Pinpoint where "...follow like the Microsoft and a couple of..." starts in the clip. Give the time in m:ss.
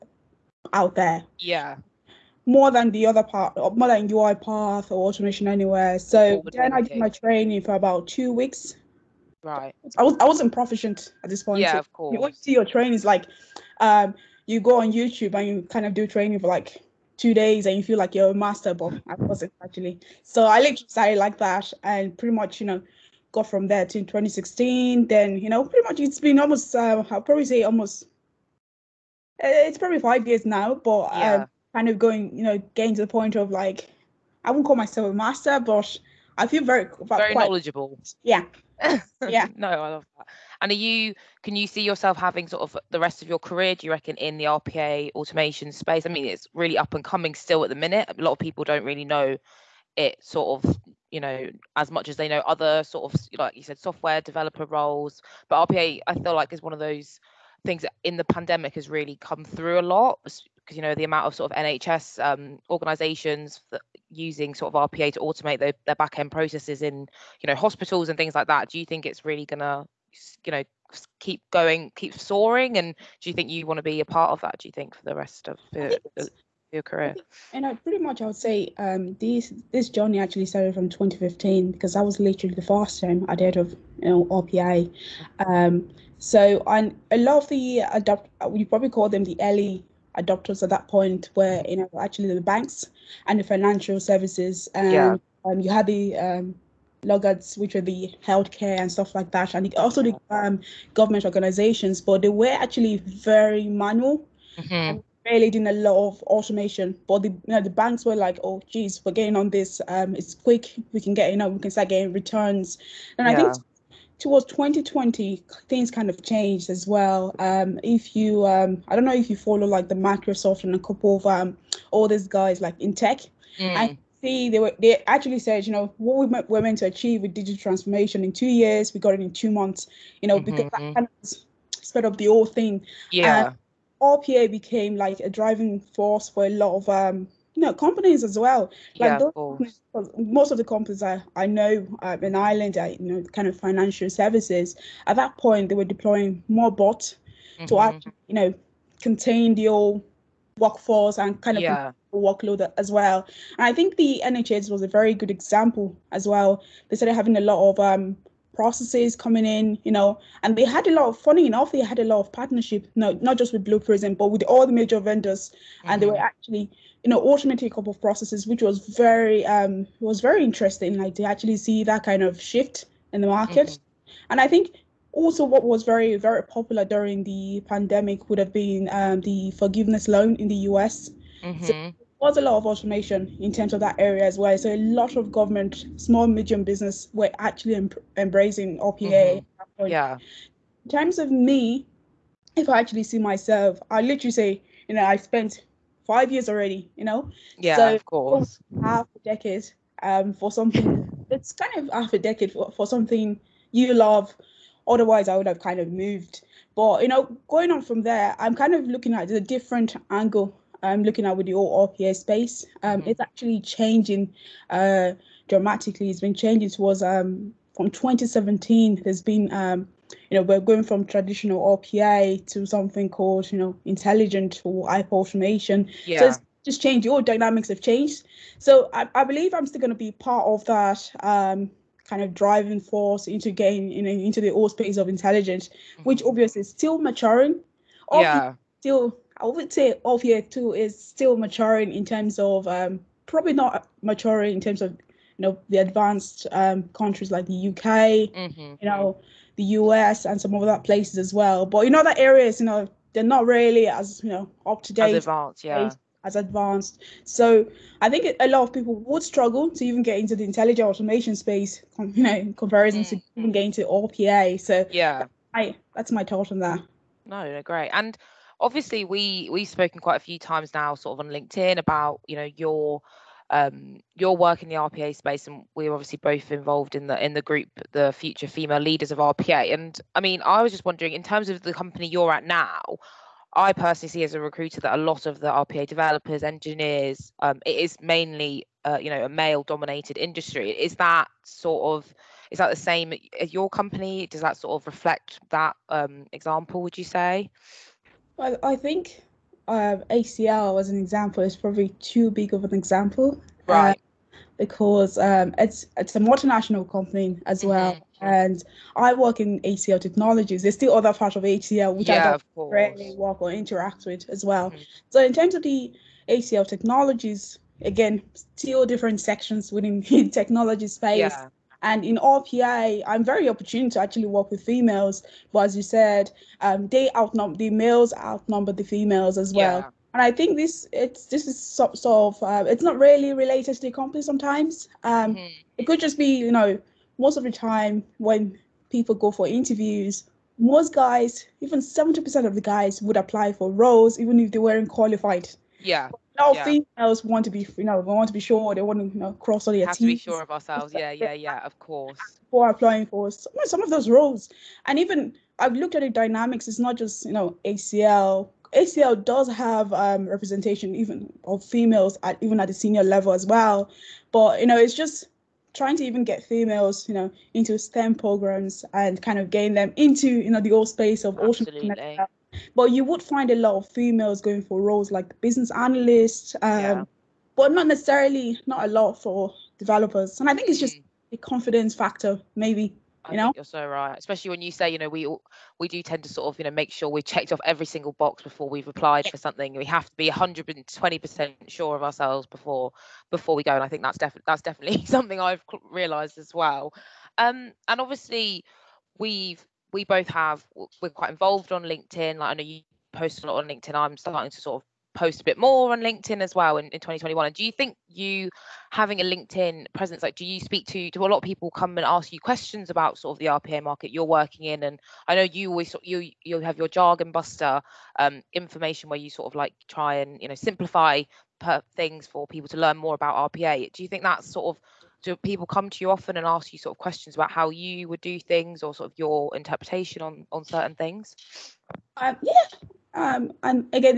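1:59.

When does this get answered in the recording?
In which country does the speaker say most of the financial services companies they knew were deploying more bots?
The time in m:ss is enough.
2:22.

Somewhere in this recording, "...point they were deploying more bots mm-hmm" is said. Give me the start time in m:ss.
2:25.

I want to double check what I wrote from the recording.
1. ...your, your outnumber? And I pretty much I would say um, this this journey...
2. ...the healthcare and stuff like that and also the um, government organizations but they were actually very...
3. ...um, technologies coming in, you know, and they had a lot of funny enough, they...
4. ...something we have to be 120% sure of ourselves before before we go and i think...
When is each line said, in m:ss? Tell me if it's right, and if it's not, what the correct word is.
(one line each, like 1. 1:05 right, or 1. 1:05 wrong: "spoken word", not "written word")
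1. 1:15 wrong: "career", not "outnumber"
2. 1:37 right
3. 2:37 wrong: "processes", not "technologies"
4. 6:29 right.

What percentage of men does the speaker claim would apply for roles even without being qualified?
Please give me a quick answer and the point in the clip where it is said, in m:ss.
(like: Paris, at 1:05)
70%, at 5:41.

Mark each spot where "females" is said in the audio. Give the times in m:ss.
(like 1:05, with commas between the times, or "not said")
4:38, 5:24, 5:28, 5:46, 6:01, 6:06, 6:13.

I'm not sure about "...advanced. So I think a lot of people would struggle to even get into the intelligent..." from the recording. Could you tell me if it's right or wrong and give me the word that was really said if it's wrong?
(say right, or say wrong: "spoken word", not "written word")
right.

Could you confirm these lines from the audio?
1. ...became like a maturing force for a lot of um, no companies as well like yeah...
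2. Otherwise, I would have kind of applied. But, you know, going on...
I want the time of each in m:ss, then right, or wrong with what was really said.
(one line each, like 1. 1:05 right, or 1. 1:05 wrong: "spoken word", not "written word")
1. 2:14 wrong: "driving", not "maturing"
2. 3:24 wrong: "moved", not "applied".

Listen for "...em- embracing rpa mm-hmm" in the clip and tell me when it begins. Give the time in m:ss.
3:07.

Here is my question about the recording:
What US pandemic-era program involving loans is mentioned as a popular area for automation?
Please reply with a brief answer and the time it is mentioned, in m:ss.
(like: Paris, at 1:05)
forgiveness loan, at 2:59.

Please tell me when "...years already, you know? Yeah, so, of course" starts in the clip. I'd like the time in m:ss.
3:16.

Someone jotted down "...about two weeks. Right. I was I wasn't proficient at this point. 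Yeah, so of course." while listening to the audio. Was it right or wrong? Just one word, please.
right.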